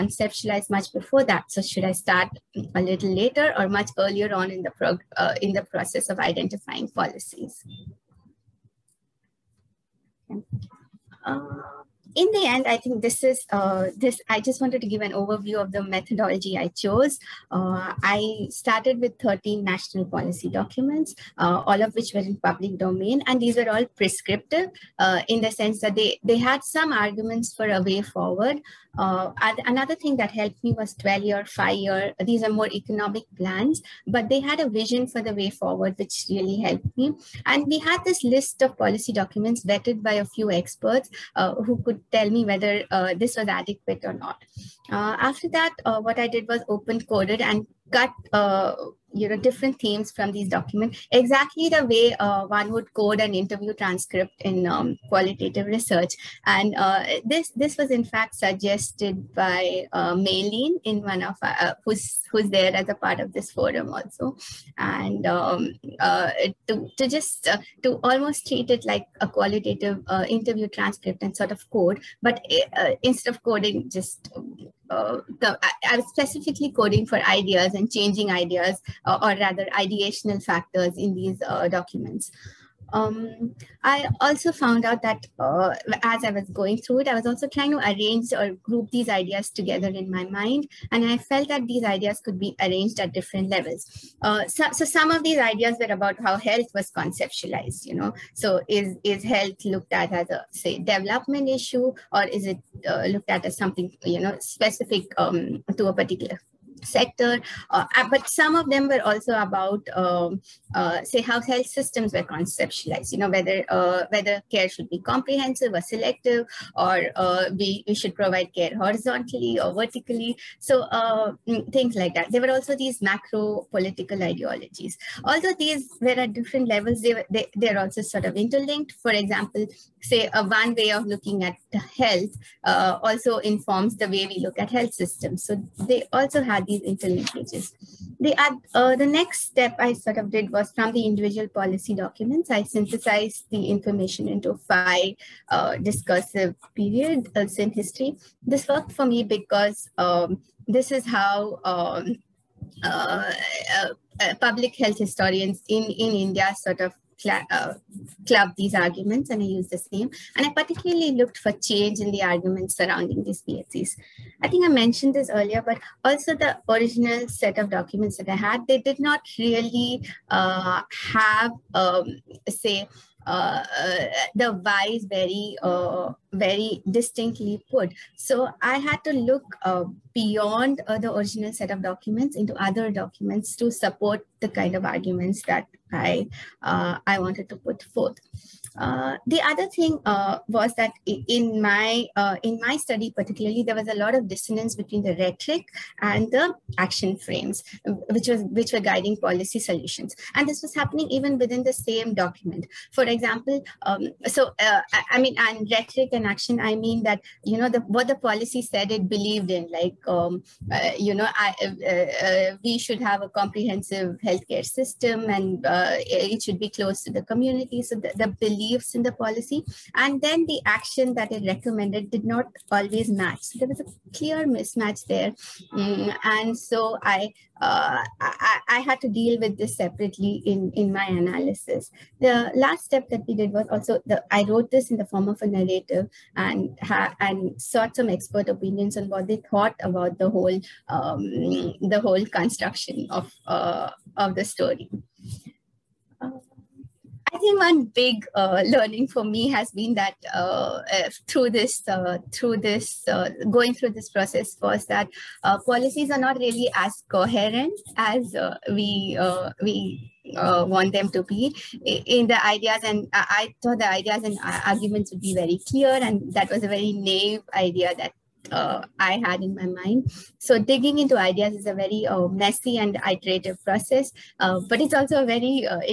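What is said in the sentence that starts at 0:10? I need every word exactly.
Okay in the end, I think this is uh, this.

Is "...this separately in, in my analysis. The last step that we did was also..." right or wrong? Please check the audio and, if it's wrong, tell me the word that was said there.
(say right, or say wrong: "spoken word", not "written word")
right.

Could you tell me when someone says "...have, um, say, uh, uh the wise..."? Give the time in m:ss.
2:51.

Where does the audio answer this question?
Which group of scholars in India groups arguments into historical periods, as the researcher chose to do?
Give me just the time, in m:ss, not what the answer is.
2:34.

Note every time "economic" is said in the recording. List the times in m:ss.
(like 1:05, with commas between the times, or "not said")
0:32.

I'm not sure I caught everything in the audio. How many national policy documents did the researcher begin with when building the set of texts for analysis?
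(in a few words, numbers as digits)
13.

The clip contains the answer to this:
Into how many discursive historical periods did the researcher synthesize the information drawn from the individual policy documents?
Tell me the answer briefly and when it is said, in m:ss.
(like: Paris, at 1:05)
5, at 2:24.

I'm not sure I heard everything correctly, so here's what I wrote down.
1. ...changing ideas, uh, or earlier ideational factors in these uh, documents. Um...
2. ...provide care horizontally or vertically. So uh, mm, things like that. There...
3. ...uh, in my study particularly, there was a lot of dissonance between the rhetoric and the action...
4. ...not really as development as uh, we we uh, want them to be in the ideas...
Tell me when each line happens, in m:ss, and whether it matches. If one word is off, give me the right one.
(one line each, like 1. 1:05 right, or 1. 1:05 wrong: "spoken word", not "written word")
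1. 1:17 wrong: "rather", not "earlier"
2. 1:58 right
3. 3:12 right
4. 4:16 wrong: "coherent", not "development".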